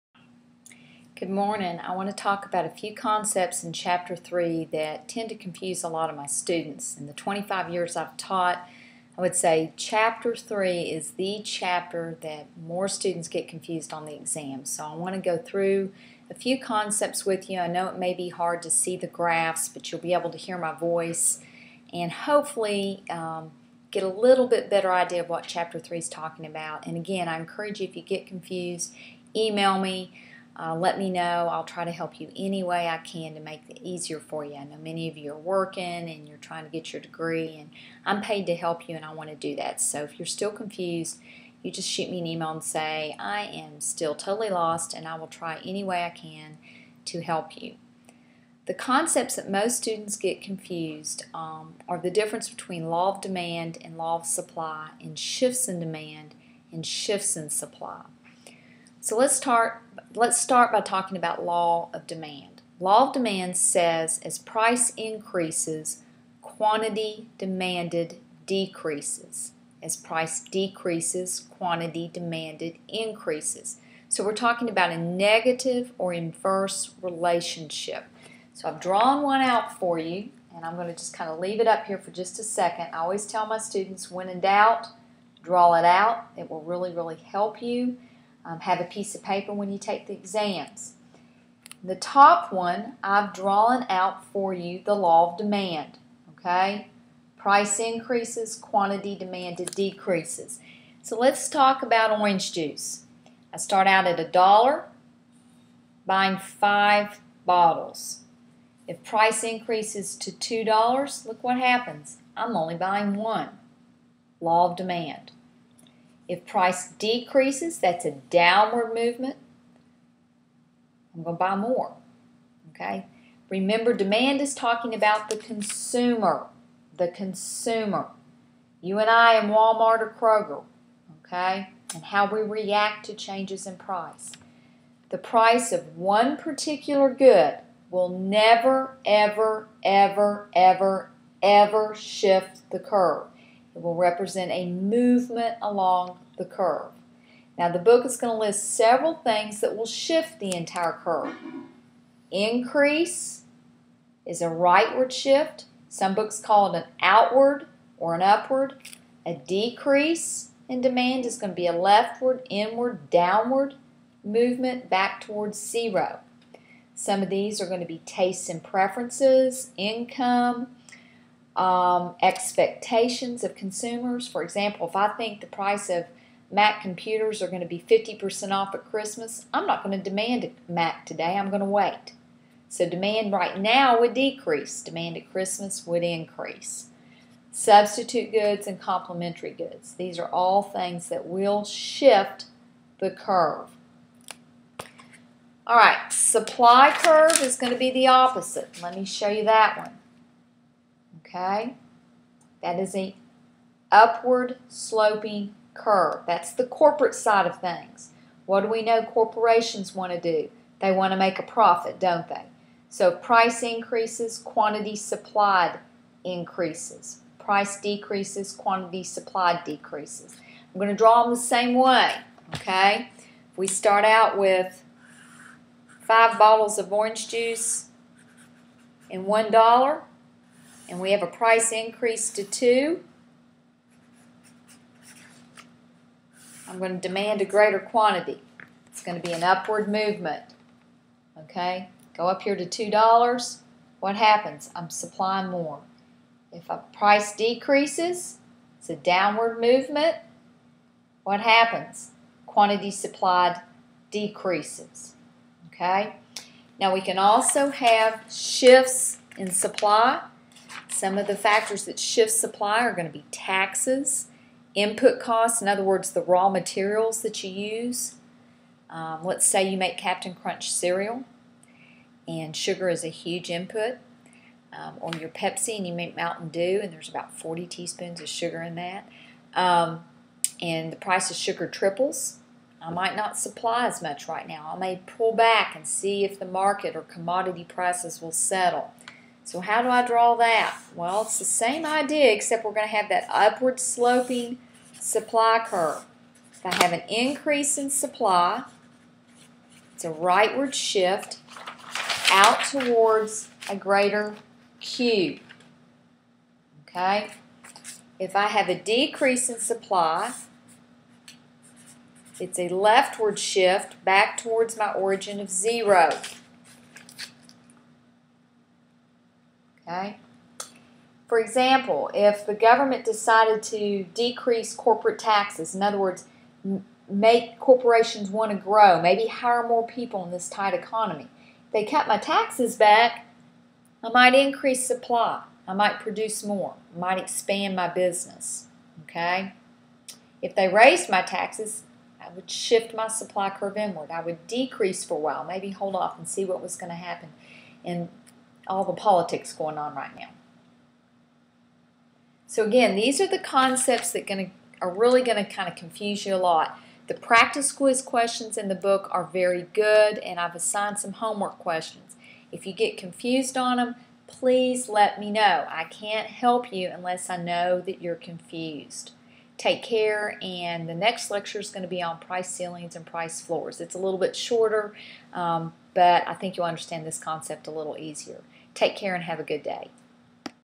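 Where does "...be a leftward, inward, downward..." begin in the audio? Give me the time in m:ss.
2:41.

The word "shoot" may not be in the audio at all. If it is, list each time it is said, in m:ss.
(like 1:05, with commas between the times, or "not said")
0:41.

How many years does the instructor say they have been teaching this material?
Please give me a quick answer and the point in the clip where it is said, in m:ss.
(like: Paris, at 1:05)
25, at 0:07.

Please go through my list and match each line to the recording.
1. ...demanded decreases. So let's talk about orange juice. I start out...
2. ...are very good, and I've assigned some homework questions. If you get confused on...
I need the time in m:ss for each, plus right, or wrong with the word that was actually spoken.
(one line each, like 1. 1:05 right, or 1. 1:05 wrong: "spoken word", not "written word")
1. 1:39 right
2. 5:59 right.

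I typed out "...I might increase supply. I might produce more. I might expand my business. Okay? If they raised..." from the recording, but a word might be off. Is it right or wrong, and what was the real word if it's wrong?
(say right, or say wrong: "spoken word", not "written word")
right.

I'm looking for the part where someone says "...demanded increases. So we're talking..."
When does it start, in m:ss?
1:12.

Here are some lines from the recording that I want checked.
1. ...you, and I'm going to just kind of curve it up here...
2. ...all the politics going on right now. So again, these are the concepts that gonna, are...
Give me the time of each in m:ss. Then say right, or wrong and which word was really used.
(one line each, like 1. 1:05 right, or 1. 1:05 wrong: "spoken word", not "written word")
1. 1:19 wrong: "leave", not "curve"
2. 5:48 right.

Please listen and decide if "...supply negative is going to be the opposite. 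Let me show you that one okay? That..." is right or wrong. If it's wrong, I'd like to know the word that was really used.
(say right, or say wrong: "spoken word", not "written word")
wrong: "curve", not "negative".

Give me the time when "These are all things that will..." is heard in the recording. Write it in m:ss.
3:09.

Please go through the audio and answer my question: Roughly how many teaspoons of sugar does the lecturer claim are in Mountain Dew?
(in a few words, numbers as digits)
40.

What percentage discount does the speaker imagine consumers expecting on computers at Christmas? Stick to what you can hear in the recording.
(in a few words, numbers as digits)
50%.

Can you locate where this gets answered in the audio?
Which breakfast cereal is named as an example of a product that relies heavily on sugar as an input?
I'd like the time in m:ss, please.
4:29.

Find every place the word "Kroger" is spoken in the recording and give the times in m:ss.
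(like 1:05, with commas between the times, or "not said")
2:10.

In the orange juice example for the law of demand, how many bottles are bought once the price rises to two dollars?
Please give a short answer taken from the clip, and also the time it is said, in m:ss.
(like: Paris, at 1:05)
1, at 1:52.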